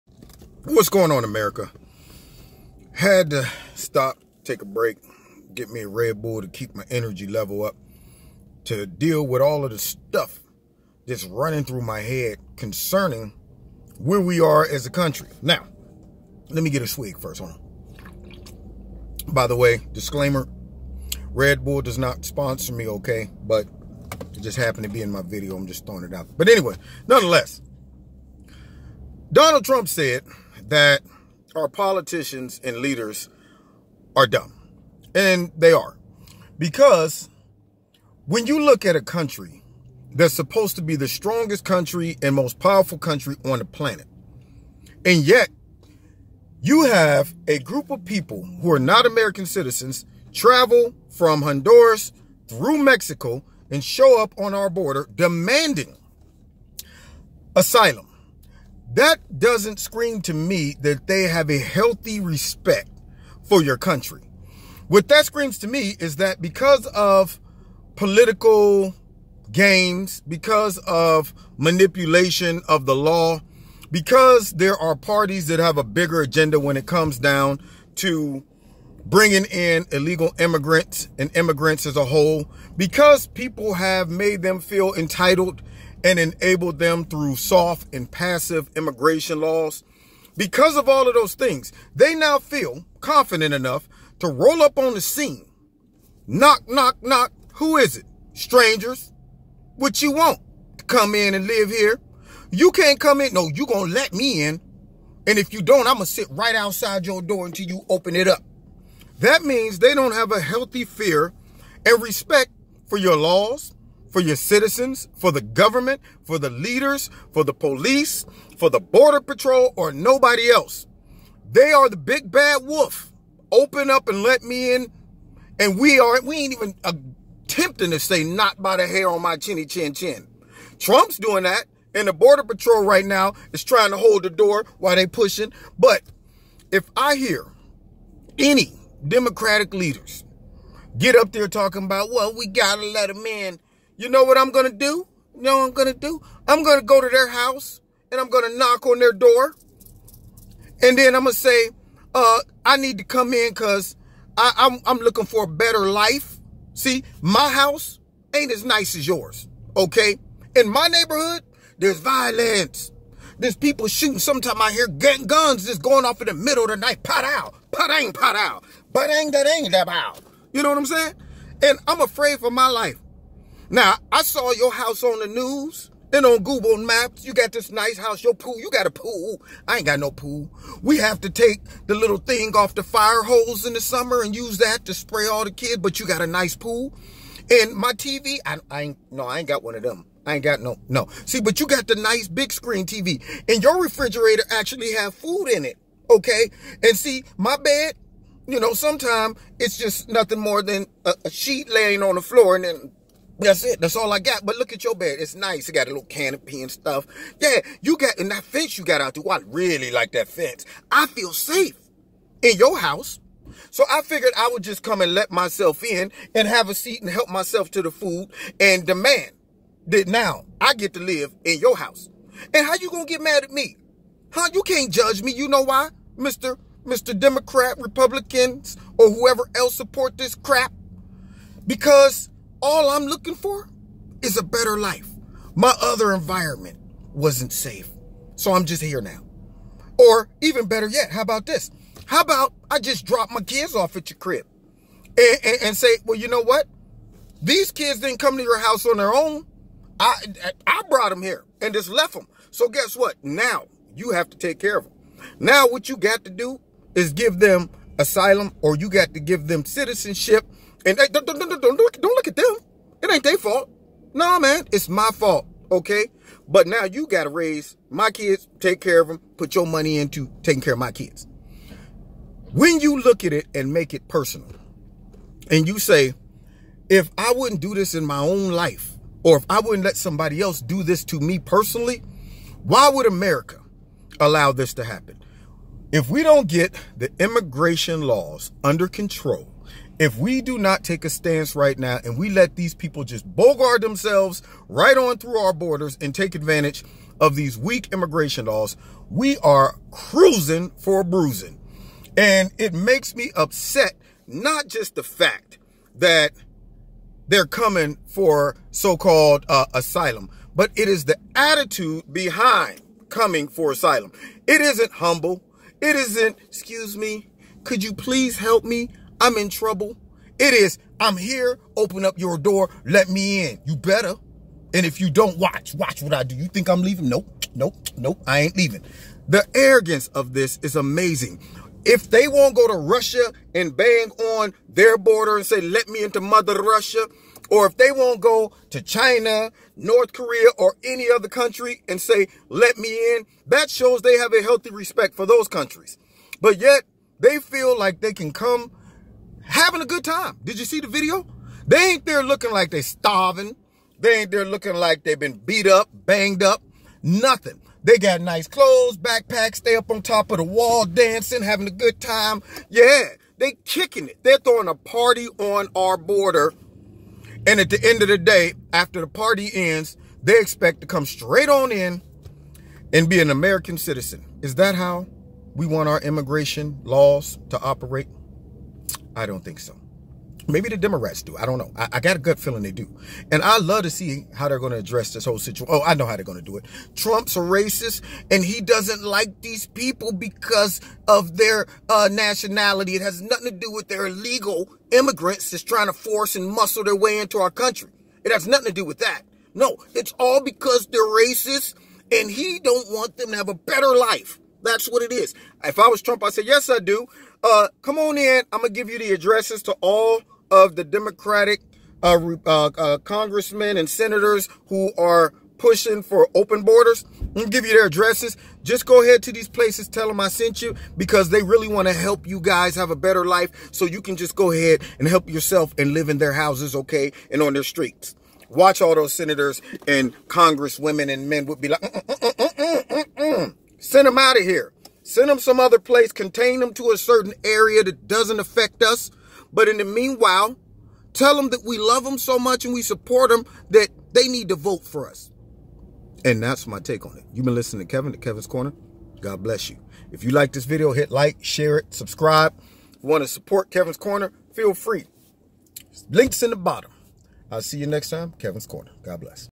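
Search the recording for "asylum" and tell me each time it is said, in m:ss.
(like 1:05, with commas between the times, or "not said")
0:57, 4:18, 5:09, 5:13.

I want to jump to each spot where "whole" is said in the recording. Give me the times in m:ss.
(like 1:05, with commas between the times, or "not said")
1:22, 6:25.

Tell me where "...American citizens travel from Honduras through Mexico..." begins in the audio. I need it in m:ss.
0:49.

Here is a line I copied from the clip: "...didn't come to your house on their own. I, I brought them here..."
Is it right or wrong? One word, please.
right.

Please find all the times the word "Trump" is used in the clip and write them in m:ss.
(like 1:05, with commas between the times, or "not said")
0:29, 2:10, 6:26, 6:46.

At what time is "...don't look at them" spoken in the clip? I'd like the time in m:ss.
4:22.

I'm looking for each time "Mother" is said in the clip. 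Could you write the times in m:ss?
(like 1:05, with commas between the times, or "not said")
5:36.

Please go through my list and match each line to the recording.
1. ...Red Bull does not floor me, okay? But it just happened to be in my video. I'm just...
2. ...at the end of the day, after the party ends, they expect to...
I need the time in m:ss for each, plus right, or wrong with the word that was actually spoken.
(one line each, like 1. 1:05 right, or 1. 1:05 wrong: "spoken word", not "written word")
1. 0:21 wrong: "sponsor", not "floor"
2. 6:07 right.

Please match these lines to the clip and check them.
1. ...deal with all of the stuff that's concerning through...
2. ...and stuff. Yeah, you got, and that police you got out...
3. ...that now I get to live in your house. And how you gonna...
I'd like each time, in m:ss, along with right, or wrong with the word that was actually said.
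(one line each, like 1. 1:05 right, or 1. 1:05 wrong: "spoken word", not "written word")
1. 0:08 wrong: "running", not "concerning"
2. 3:26 wrong: "fence", not "police"
3. 3:39 right.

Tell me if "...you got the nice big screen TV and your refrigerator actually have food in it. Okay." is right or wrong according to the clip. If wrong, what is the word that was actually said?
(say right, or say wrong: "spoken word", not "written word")
right.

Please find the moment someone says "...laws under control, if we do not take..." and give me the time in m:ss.
4:48.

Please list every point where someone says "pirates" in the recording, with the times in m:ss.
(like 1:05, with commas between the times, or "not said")
not said.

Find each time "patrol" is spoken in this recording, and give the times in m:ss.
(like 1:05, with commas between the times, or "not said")
1:59, 2:12.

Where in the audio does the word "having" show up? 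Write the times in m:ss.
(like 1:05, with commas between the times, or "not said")
5:49, 6:01.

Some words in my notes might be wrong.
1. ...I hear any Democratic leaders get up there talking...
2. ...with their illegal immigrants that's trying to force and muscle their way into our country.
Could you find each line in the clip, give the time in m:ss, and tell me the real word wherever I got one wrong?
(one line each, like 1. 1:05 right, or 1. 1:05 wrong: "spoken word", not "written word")
1. 2:16 right
2. 6:33 right.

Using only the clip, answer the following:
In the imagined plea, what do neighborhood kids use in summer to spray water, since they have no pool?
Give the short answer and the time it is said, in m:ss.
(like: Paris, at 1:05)
The fire hose, at 3:02.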